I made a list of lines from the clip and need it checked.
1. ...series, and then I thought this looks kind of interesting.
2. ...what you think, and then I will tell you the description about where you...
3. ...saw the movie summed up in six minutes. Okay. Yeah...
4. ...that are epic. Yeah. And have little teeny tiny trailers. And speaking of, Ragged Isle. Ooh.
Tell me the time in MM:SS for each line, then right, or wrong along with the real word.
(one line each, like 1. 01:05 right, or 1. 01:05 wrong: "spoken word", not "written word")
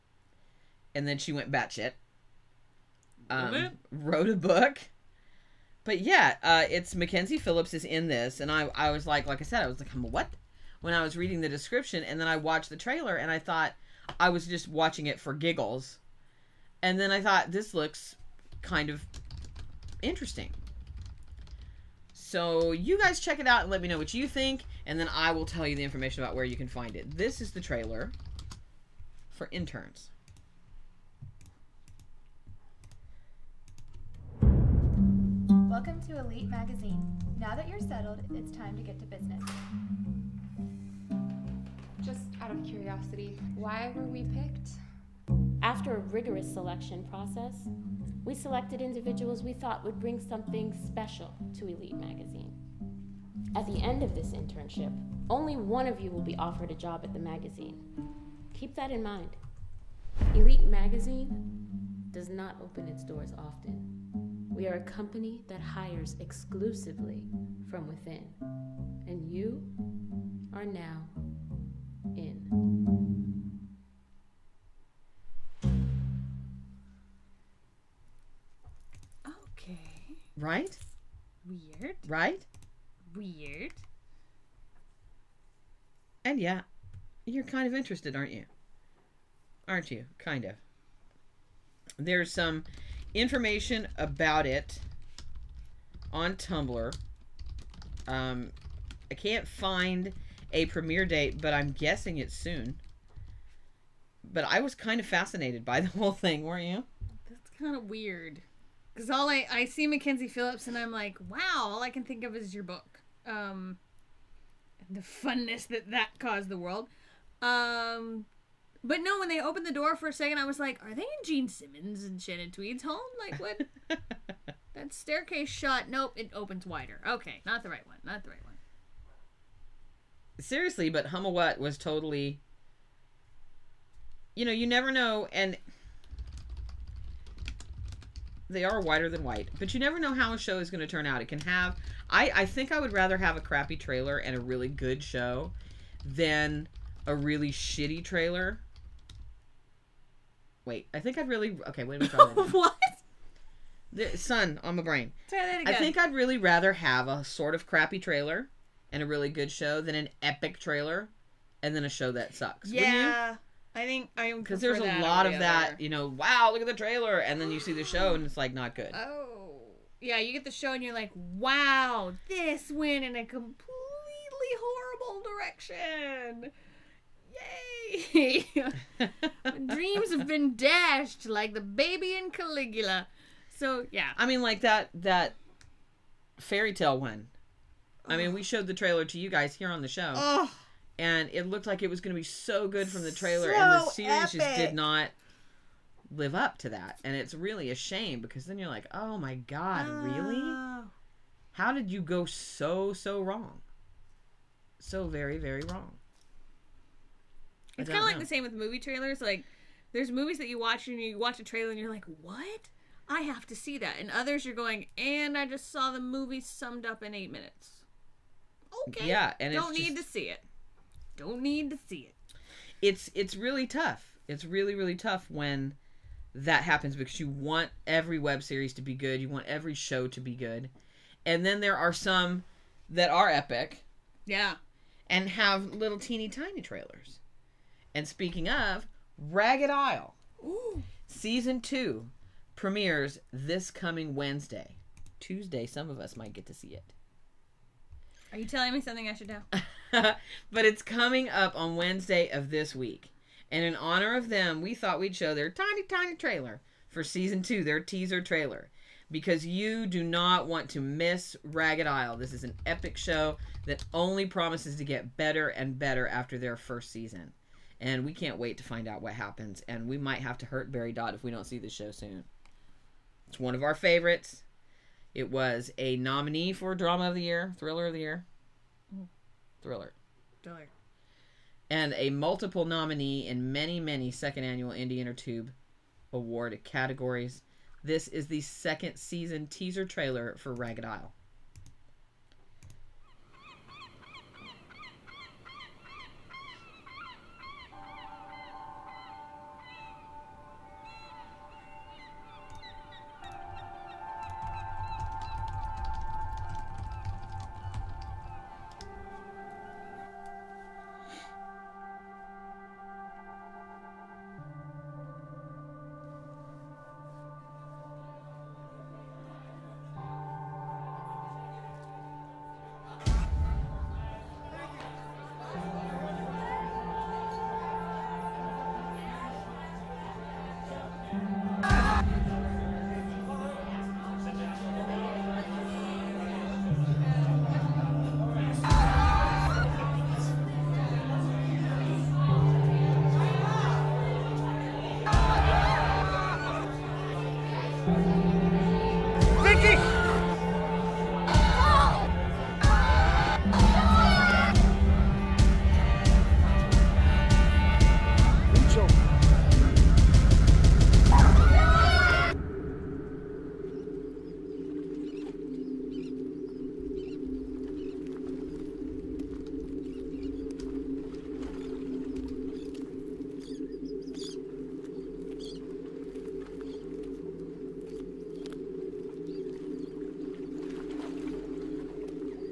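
1. 00:15 wrong: "giggles", not "series"
2. 00:23 wrong: "information", not "description"
3. 03:35 wrong: "eight", not "six"
4. 03:52 right.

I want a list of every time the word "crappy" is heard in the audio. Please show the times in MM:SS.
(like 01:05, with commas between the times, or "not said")
02:23, 02:37.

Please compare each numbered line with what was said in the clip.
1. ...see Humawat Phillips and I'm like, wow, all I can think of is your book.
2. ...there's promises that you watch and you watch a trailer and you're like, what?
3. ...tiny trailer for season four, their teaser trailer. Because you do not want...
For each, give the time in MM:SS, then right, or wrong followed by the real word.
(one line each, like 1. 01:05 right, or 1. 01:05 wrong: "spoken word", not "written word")
1. 01:49 wrong: "Mackenzie", not "Humawat"
2. 03:29 wrong: "movies", not "promises"
3. 04:15 wrong: "two", not "four".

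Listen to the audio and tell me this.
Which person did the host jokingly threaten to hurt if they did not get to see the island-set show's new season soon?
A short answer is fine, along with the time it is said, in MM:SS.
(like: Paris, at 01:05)
Barry Dodd, at 04:30.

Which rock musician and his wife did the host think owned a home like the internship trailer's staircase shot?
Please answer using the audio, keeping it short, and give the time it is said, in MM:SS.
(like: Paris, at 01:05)
Gene Simmons and Shannon Tweed, at 02:01.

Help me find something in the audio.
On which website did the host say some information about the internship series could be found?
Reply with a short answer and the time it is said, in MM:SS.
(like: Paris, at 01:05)
Tumblr, at 01:36.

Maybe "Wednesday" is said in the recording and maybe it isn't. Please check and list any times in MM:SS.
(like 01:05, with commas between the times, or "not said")
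04:04, 04:11.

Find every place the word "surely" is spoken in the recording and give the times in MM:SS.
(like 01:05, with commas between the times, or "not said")
not said.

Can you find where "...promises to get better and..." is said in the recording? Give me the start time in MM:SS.
04:24.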